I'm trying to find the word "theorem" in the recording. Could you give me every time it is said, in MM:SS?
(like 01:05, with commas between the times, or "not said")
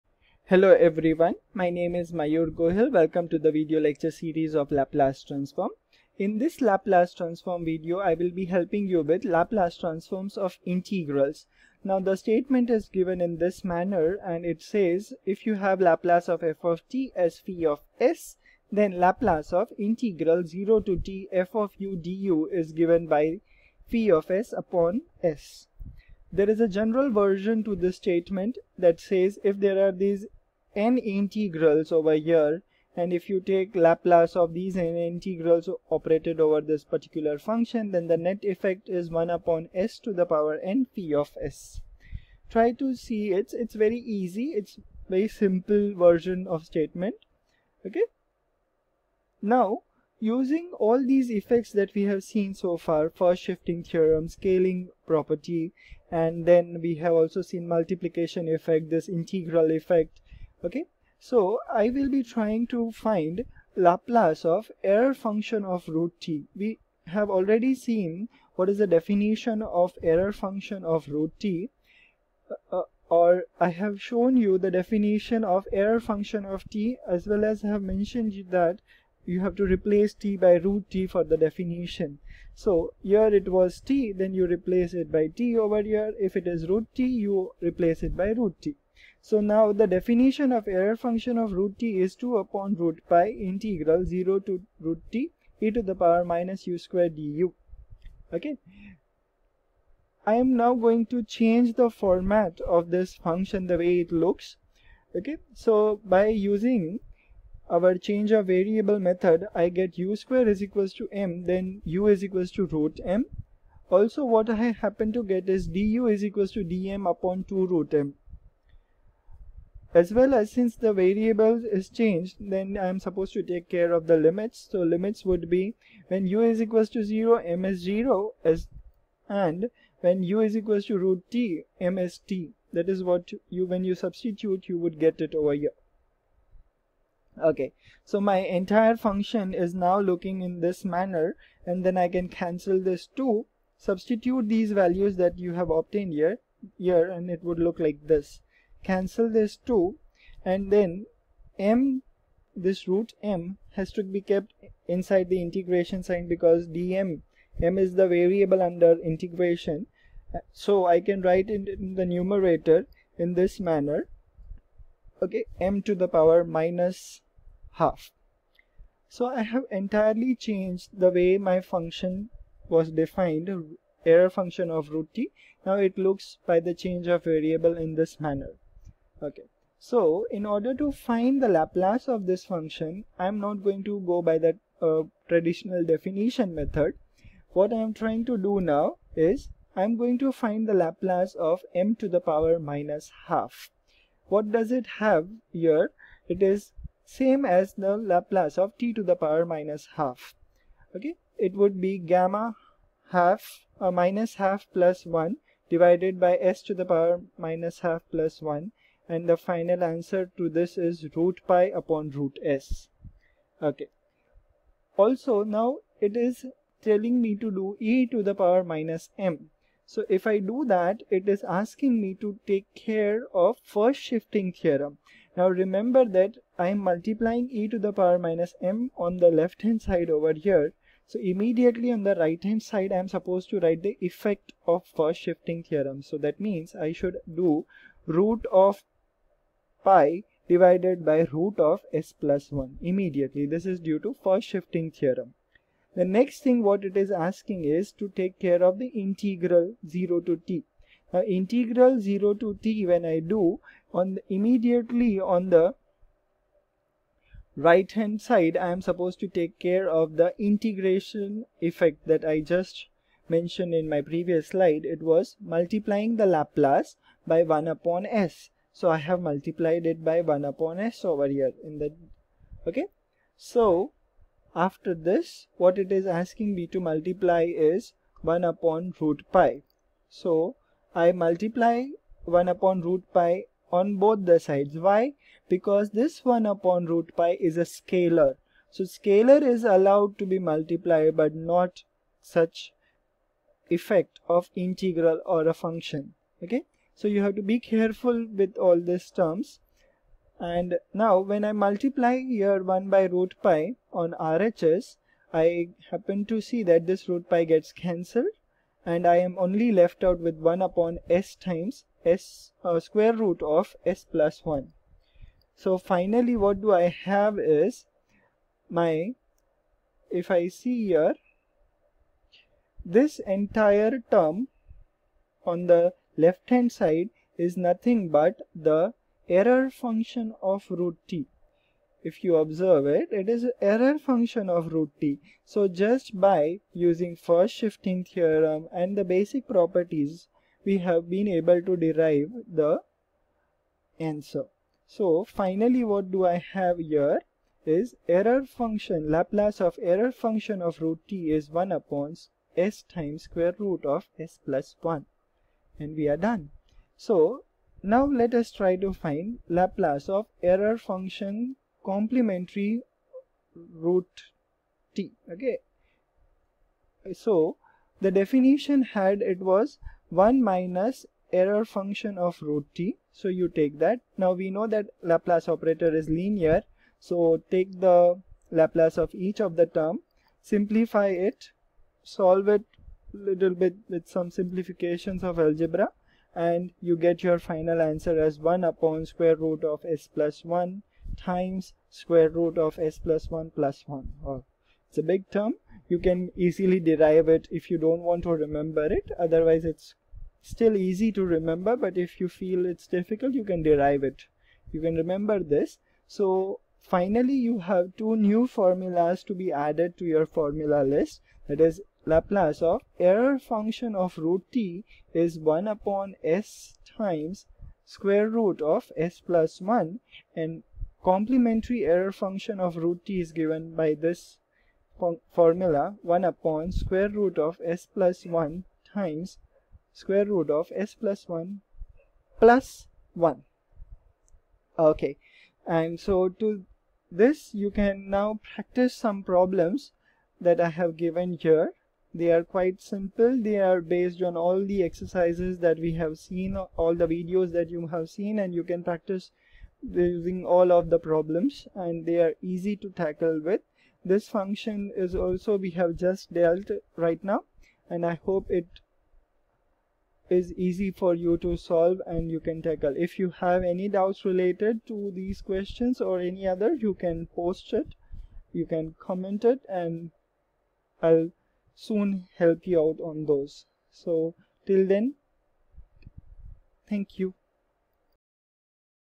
00:53, 03:44, 03:55, 04:04, 05:38.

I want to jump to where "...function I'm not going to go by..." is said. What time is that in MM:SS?
03:02.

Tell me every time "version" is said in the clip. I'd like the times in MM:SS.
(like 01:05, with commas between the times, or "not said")
00:27, 00:45.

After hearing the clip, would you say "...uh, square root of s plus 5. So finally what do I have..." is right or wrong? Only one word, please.
wrong.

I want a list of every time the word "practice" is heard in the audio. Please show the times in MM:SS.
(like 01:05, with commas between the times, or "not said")
07:18, 07:28.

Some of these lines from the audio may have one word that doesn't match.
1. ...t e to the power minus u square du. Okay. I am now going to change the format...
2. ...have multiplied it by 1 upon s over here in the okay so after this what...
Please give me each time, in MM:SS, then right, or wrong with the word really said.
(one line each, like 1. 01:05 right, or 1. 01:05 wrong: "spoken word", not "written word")
1. 01:35 right
2. 04:28 right.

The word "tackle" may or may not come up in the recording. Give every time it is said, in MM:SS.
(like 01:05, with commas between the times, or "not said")
07:32, 07:42.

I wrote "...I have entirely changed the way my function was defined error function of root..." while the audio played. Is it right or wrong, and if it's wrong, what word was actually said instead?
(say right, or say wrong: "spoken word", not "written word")
right.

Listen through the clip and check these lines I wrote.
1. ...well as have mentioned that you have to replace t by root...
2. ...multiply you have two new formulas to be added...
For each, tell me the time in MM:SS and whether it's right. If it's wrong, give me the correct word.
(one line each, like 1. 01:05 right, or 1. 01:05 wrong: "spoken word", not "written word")
1. 01:17 right
2. 06:46 wrong: "finally", not "multiply".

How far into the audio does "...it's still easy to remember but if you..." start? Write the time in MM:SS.
06:39.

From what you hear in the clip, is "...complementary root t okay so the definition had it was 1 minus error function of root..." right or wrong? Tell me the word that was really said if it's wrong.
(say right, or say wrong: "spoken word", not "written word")
right.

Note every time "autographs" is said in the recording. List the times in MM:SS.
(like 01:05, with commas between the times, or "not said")
not said.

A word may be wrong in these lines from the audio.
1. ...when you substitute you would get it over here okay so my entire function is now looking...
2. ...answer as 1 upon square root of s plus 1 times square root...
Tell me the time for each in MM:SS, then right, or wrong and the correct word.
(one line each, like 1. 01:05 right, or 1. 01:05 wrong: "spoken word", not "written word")
1. 02:13 right
2. 06:27 right.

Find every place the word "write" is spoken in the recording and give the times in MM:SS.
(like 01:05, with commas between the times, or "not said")
02:41, 03:53.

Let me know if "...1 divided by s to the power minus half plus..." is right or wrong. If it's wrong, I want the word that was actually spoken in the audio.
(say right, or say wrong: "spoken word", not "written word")
right.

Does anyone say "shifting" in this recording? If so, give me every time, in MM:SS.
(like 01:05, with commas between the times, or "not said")
00:53, 03:43, 03:55, 04:04, 05:37.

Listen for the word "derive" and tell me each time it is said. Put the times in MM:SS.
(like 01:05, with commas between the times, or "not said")
05:41, 06:36, 06:43.